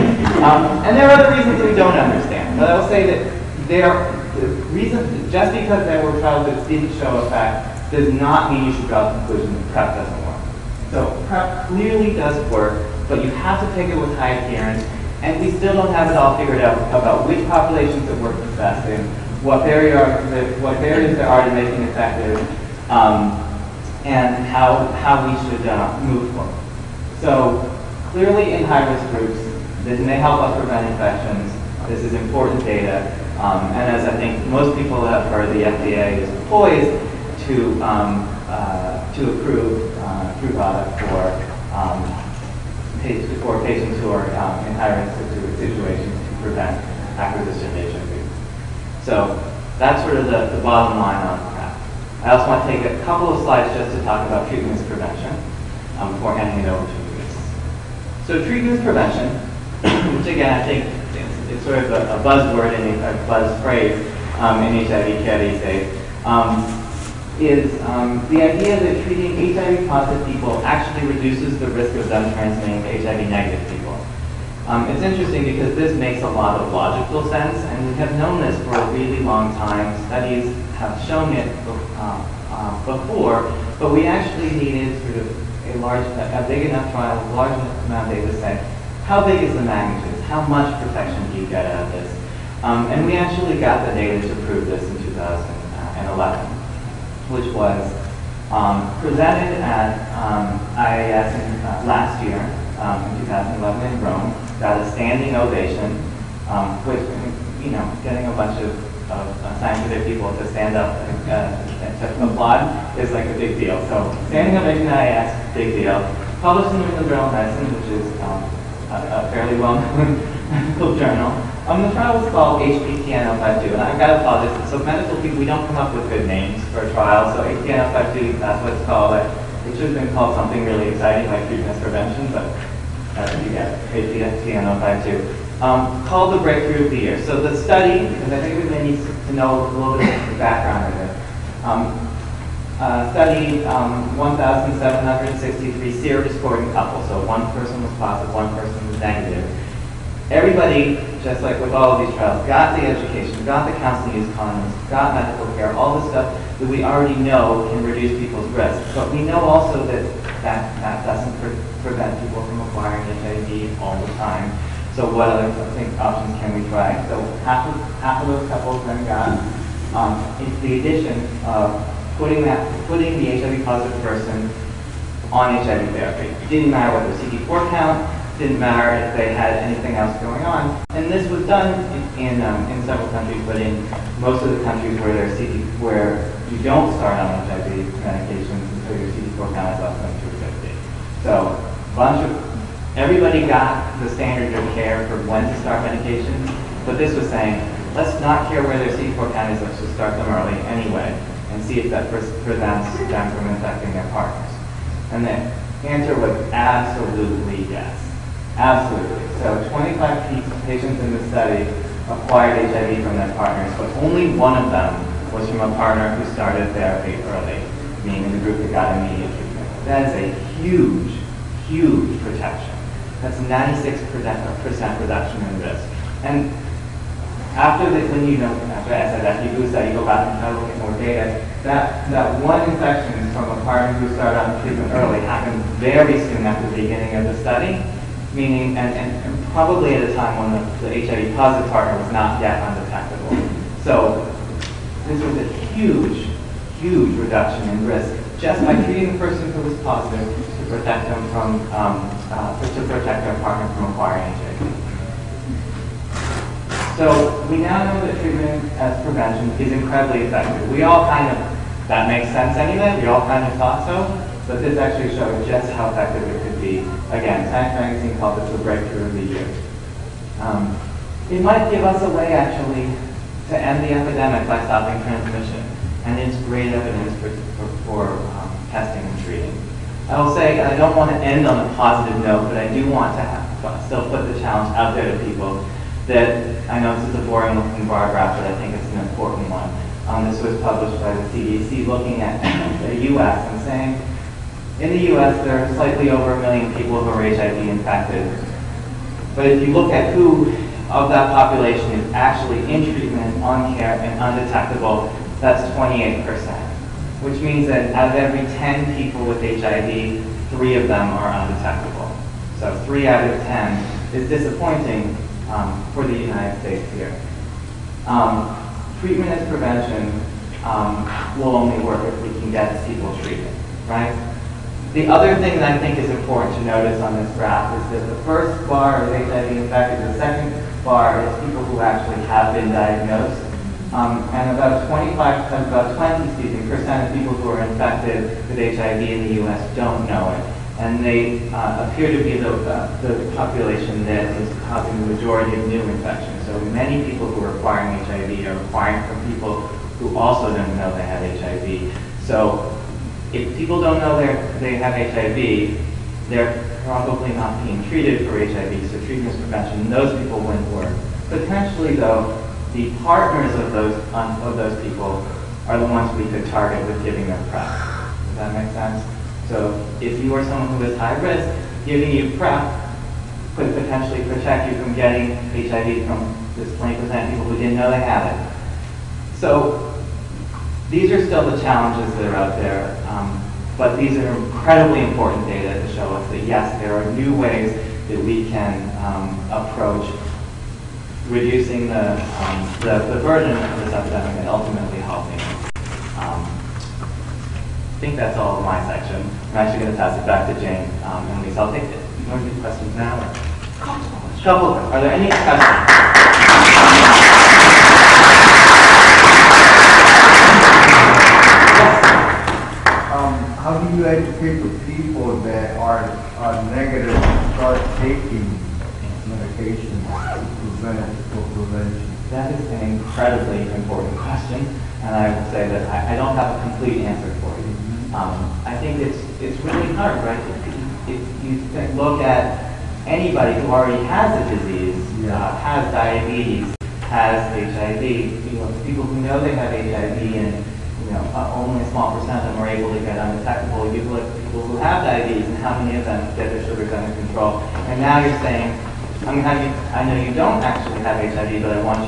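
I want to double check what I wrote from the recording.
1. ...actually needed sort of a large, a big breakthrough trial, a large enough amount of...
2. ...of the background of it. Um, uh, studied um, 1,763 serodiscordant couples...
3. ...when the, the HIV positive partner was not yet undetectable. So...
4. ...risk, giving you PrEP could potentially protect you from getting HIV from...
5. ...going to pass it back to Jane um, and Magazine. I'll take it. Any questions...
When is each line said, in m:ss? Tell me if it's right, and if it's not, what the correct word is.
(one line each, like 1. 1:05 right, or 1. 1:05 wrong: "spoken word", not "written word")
1. 1:24 wrong: "enough", not "breakthrough"
2. 2:20 right
3. 4:00 right
4. 6:11 right
5. 6:39 wrong: "Lisa", not "Magazine".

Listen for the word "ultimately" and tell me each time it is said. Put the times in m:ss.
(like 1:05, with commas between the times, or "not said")
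6:34.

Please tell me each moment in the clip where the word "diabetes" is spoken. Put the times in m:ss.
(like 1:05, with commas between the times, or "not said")
7:15, 7:25.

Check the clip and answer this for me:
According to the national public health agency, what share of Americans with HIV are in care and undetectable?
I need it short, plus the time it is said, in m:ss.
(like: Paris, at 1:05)
28%, at 5:05.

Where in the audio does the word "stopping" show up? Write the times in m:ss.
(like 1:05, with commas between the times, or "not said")
4:34.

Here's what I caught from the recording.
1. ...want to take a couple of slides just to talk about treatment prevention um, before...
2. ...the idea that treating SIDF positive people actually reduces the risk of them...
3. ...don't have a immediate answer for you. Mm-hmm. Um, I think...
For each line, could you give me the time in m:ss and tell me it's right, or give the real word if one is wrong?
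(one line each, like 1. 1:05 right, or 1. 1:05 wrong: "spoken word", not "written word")
1. 0:52 right
2. 1:08 wrong: "HIV", not "SIDF"
3. 7:06 wrong: "complete", not "immediate".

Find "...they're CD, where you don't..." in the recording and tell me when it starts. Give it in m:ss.
3:05.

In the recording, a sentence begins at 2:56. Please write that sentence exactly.
It didn't matter whether CD4 count, didn't matter if they had anything else going on.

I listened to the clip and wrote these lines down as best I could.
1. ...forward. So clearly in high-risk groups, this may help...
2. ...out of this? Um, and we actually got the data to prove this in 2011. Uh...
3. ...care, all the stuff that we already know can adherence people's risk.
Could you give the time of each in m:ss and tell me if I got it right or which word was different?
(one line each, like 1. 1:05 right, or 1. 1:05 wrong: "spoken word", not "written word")
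1. 0:26 right
2. 1:31 right
3. 2:35 wrong: "reduce", not "adherence".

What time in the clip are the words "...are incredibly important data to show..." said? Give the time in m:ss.
6:24.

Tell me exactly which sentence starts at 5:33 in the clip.
Um, and about 25%, about 20, percent of people who are infected with HIV in the US don't know it.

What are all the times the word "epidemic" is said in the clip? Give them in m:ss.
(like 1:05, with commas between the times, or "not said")
4:33, 6:33.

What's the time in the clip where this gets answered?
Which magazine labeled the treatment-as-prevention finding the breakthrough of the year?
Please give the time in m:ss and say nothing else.
4:27.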